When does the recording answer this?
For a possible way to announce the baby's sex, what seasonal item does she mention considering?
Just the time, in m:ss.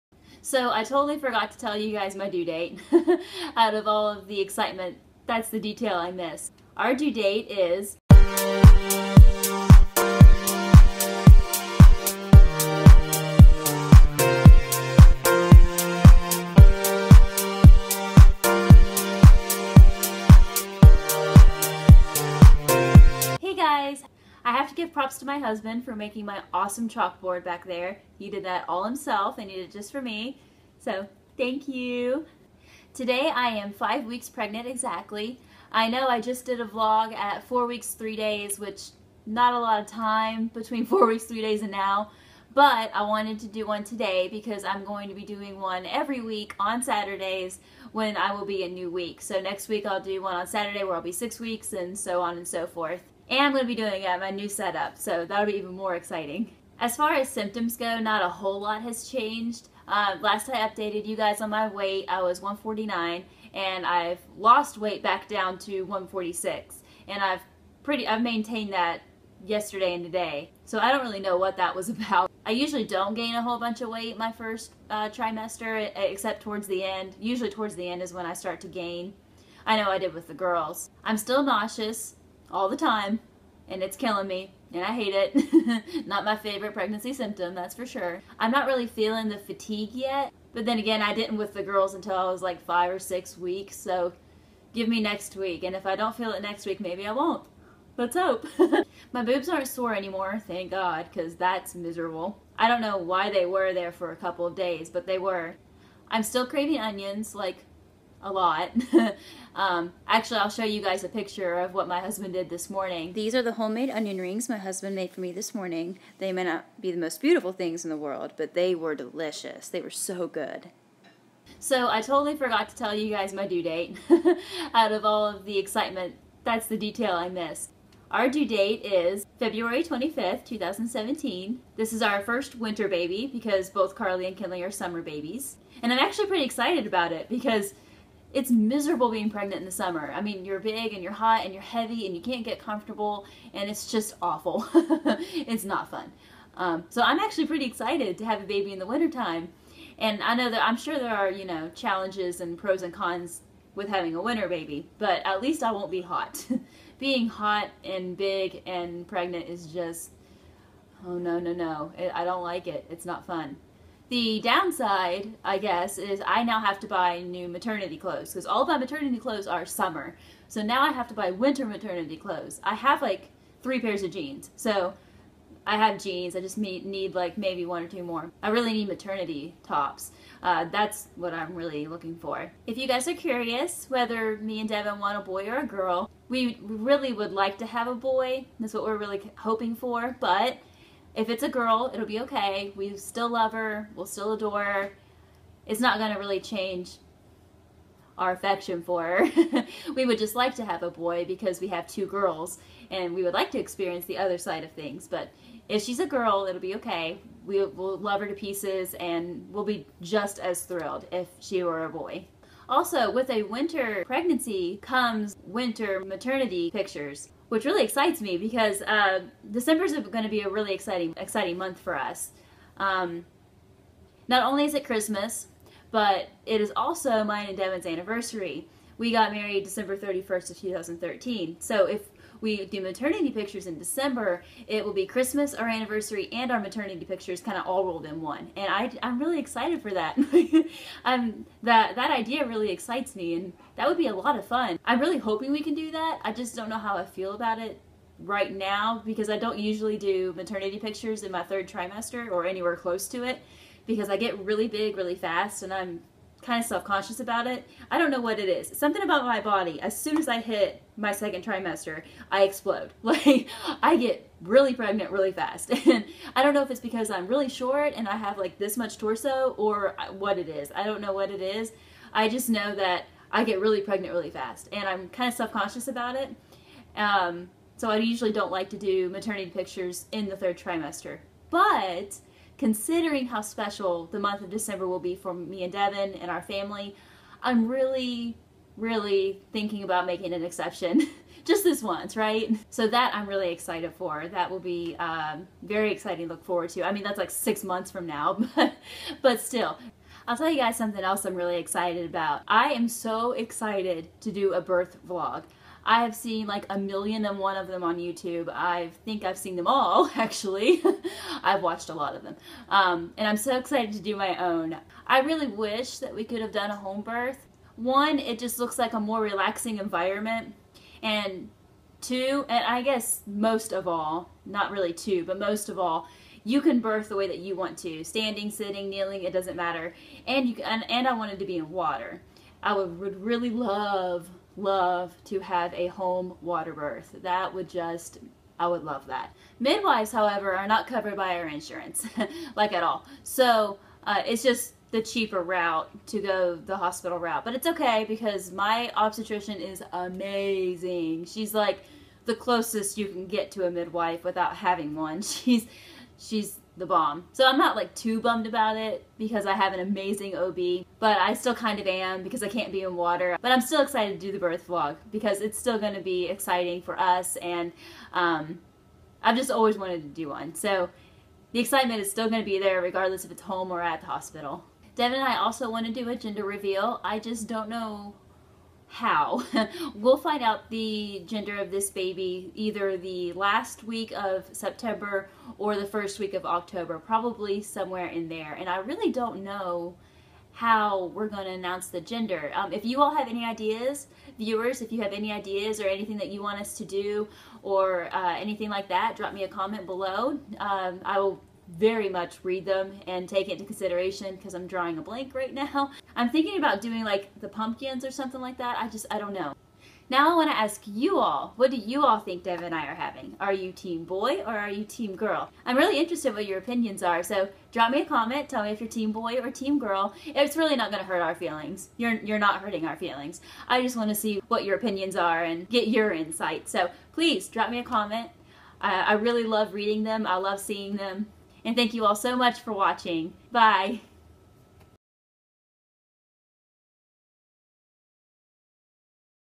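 6:47.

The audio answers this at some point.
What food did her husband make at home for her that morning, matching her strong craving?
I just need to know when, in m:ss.
1:53.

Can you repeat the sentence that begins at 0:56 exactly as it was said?
As far as symptoms go, not a whole lot has changed.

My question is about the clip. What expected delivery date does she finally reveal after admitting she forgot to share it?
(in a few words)
February 25th, 2017.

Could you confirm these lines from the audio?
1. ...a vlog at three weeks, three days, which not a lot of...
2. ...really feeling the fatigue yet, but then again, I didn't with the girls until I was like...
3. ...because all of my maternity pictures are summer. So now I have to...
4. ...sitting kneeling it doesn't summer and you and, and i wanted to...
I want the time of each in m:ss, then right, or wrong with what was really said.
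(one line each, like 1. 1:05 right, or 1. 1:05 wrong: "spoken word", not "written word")
1. 0:36 wrong: "four", not "three"
2. 1:28 right
3. 2:48 wrong: "clothes", not "pictures"
4. 5:28 wrong: "matter", not "summer".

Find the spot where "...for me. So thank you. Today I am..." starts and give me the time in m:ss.
0:29.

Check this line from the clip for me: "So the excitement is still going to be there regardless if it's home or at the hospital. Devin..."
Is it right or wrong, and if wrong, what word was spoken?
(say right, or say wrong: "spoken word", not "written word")
right.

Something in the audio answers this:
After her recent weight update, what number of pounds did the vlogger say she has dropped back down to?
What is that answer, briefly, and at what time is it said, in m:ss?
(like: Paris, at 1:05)
146, at 1:05.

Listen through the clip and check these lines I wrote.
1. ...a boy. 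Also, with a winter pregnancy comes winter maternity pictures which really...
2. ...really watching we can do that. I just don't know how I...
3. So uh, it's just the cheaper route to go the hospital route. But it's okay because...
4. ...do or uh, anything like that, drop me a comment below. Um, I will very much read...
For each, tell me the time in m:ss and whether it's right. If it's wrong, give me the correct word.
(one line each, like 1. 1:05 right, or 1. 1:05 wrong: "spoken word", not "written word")
1. 3:31 right
2. 4:04 wrong: "hoping", not "watching"
3. 5:43 right
4. 6:36 right.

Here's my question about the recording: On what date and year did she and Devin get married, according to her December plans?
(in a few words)
December 31st, 2013.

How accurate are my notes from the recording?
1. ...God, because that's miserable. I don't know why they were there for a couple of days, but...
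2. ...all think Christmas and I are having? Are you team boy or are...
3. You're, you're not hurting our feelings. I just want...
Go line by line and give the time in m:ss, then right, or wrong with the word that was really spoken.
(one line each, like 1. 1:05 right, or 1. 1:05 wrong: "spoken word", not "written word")
1. 1:40 right
2. 6:52 wrong: "Dev", not "Christmas"
3. 7:01 right.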